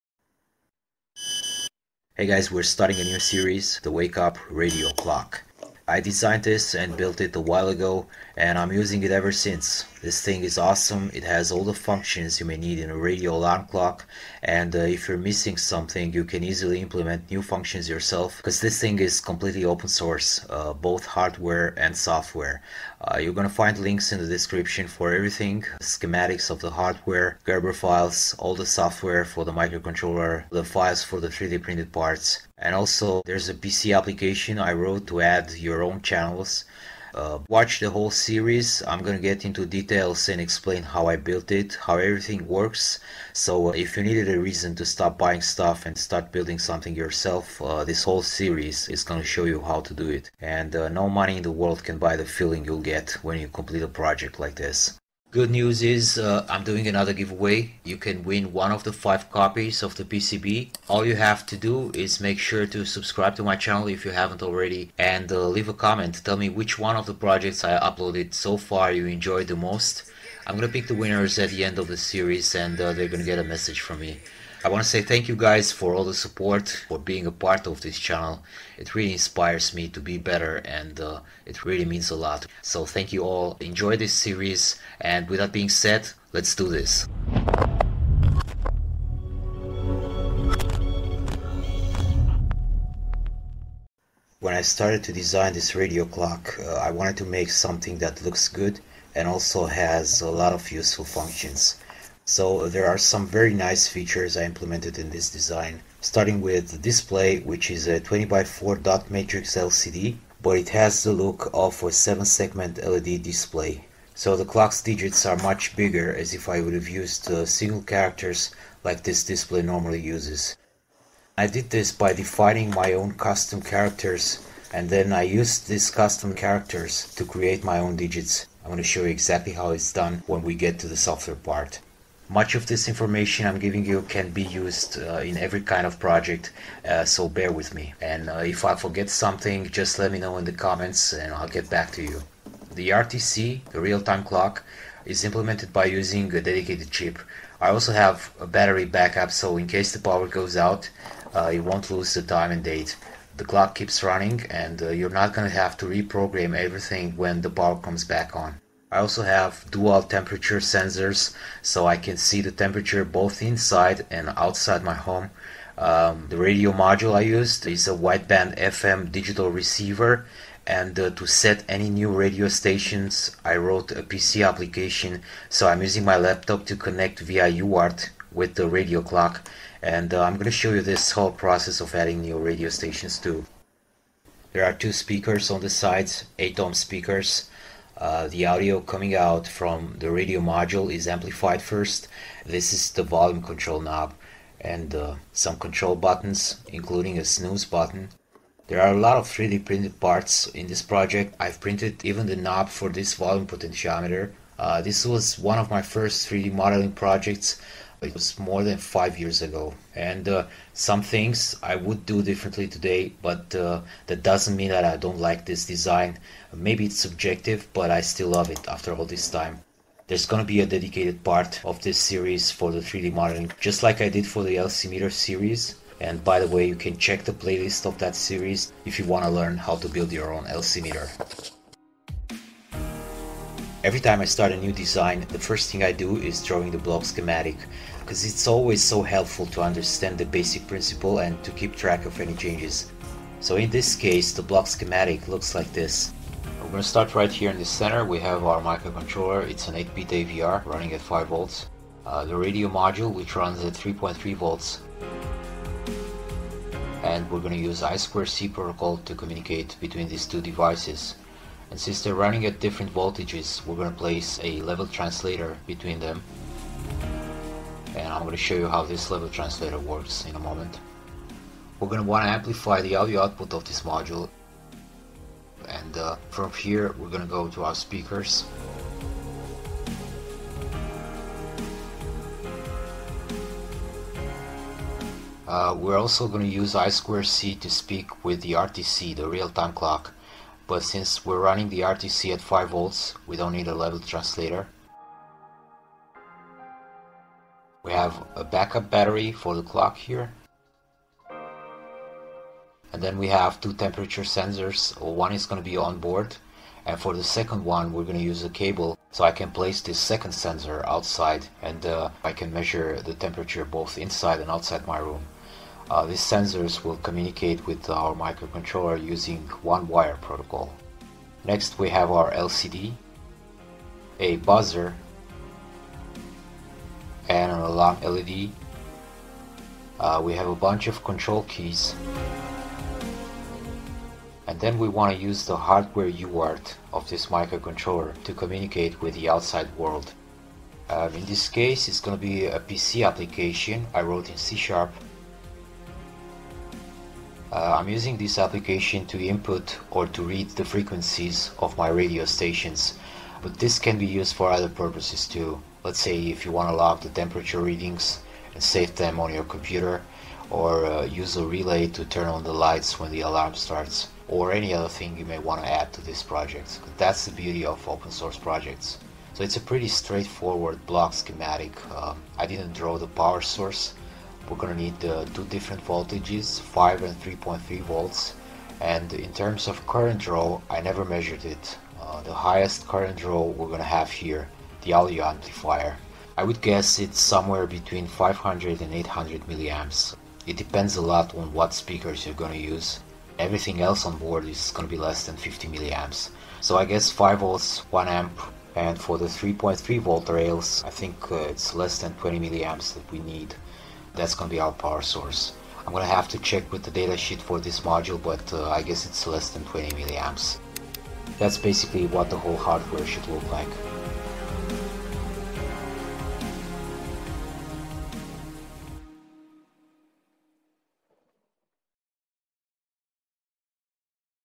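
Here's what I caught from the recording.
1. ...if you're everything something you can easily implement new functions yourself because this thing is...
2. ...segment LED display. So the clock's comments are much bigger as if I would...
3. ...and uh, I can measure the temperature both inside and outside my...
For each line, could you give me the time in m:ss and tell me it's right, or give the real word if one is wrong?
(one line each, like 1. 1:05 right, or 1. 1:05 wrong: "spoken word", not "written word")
1. 0:14 wrong: "missing", not "everything"
2. 1:52 wrong: "digits", not "comments"
3. 5:11 right.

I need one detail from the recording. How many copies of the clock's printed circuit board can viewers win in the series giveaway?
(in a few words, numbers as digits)
5.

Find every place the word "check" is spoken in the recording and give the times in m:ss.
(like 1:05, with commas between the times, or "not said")
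3:46, 6:46.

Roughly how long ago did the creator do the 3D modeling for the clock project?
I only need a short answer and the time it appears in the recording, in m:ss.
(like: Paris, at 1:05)
more than 5 years, at 3:28.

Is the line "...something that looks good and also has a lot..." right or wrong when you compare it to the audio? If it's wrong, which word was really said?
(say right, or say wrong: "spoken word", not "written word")
right.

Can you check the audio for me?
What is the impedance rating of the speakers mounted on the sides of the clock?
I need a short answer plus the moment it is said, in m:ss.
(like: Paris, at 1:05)
8 ohm, at 3:06.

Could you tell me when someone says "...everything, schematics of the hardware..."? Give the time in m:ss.
0:25.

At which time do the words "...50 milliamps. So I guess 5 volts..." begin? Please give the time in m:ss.
6:35.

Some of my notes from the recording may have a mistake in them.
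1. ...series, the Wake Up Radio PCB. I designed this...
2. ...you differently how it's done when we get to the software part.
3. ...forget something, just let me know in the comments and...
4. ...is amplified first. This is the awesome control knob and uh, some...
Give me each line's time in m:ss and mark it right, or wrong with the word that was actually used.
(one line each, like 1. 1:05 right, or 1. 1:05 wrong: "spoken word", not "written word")
1. 0:03 wrong: "Clock", not "PCB"
2. 2:09 wrong: "exactly", not "differently"
3. 2:18 right
4. 3:10 wrong: "volume", not "awesome".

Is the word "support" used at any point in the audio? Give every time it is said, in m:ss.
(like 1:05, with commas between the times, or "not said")
1:16.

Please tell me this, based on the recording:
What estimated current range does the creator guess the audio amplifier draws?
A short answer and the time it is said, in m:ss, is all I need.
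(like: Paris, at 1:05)
500 to 800 milliamps, at 6:27.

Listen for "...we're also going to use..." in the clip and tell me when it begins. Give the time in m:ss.
4:45.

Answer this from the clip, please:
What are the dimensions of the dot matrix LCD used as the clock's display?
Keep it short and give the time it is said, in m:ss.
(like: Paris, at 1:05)
20 by 4, at 1:47.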